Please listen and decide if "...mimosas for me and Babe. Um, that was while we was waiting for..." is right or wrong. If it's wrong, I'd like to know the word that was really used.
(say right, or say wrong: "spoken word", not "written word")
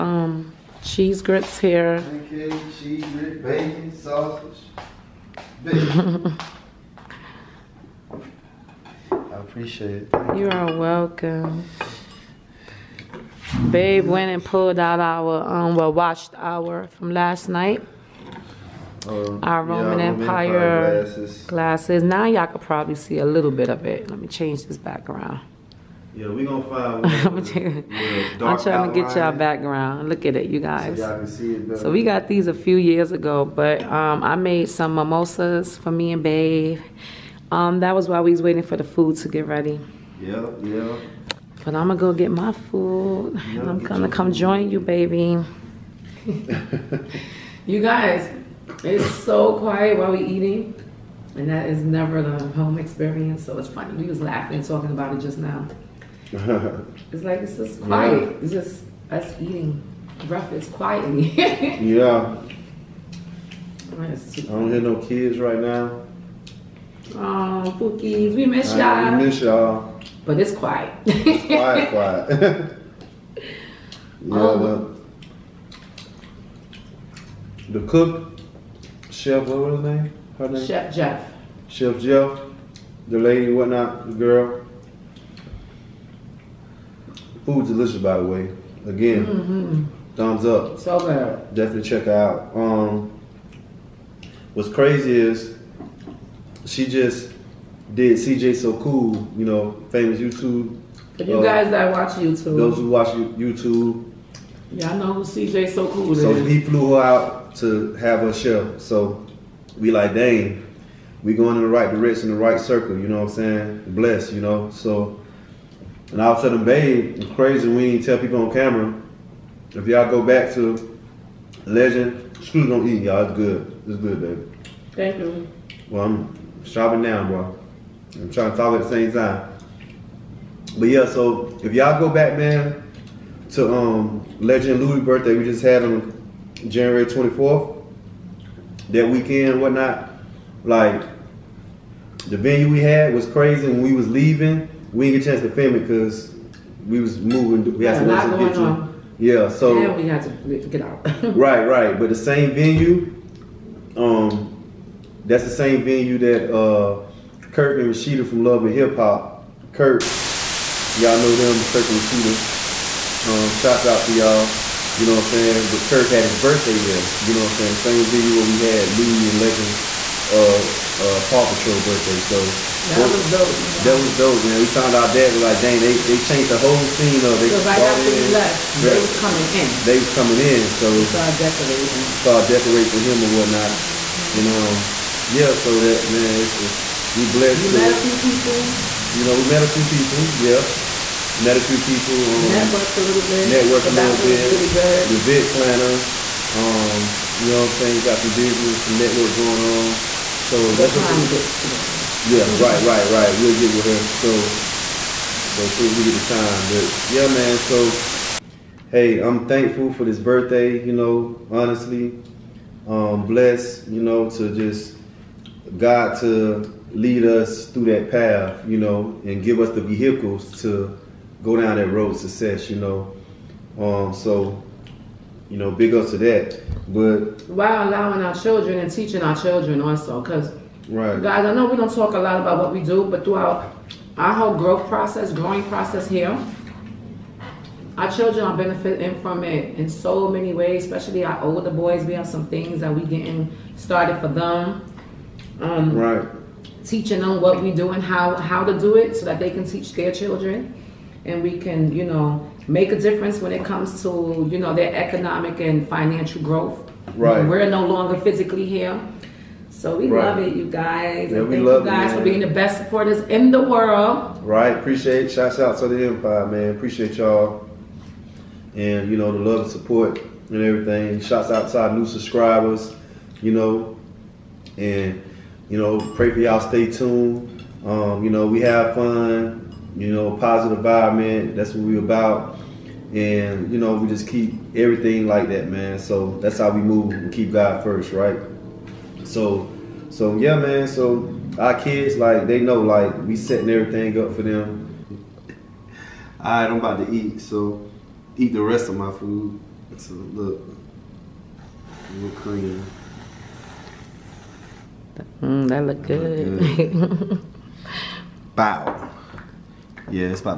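right.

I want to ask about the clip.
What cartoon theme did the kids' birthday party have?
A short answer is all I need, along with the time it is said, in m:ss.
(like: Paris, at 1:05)
Paw Patrol, at 2:51.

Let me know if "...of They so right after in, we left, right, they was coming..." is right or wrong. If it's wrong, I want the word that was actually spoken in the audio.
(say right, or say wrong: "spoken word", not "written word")
right.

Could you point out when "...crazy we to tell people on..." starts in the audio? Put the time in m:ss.
1:57.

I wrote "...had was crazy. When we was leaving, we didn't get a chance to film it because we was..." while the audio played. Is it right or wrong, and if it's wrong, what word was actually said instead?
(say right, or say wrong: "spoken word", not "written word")
right.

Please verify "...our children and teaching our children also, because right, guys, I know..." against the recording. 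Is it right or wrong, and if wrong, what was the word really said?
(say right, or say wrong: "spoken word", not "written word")
right.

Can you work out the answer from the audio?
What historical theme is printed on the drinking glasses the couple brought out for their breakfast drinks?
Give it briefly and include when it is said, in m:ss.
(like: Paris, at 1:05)
Roman Empire, at 0:20.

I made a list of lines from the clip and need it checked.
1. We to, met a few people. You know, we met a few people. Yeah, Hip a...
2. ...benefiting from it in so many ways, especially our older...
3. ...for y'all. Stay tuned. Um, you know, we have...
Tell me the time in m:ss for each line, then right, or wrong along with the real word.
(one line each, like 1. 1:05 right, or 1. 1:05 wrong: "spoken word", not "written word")
1. 3:07 wrong: "Met", not "Hip"
2. 3:58 right
3. 4:36 right.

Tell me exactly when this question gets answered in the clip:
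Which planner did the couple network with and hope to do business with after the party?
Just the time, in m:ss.
3:15.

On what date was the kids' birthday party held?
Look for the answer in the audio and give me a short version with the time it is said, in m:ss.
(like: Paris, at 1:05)
January 24th, at 2:16.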